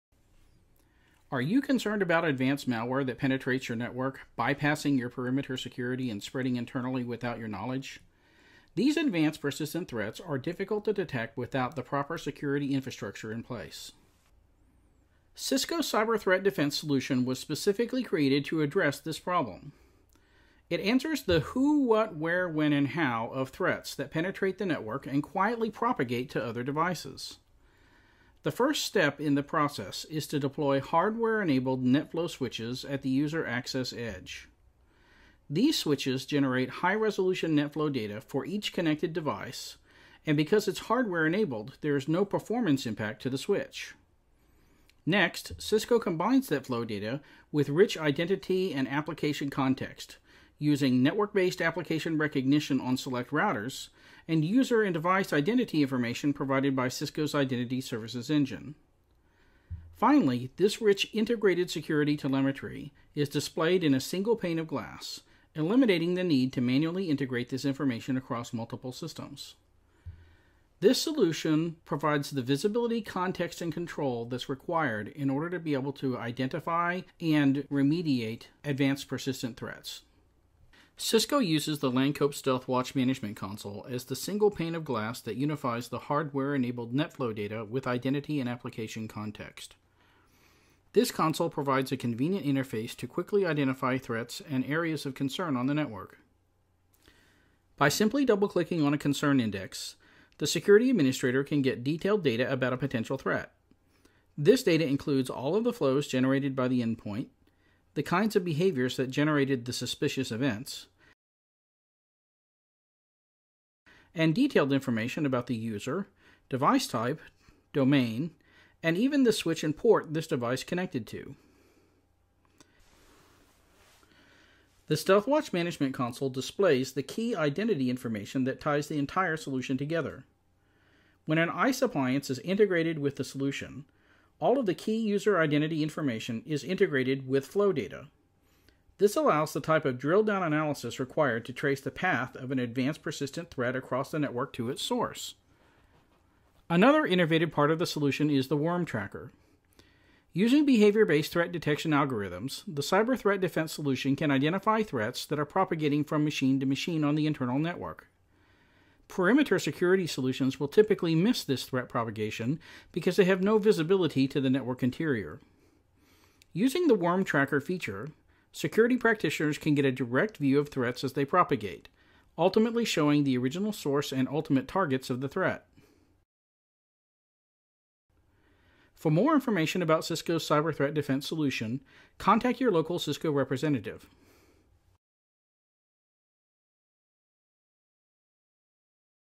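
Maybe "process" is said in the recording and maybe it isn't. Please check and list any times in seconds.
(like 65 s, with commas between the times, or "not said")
29 s.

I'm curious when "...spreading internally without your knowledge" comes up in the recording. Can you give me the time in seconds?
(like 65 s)
6 s.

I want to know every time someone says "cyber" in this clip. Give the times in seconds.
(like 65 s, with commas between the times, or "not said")
15 s, 152 s, 180 s.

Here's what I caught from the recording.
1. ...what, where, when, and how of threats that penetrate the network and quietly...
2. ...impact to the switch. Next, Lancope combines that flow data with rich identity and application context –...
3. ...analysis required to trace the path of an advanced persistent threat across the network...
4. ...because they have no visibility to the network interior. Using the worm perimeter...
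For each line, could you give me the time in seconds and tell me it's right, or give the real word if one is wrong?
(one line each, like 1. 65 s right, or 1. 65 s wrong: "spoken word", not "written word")
1. 21 s right
2. 42 s wrong: "Cisco", not "Lancope"
3. 140 s right
4. 162 s wrong: "tracker", not "perimeter".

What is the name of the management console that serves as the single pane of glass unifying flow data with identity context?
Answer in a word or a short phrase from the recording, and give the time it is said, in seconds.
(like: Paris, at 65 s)
Lancope StealthWatch Management Console, at 81 s.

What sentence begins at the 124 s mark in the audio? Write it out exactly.
The StealthWatch Management Console displays the key identity information that ties the entire solution together.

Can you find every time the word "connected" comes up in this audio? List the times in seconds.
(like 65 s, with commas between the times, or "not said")
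38 s, 120 s.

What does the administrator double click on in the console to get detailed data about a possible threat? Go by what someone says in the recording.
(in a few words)
concern index.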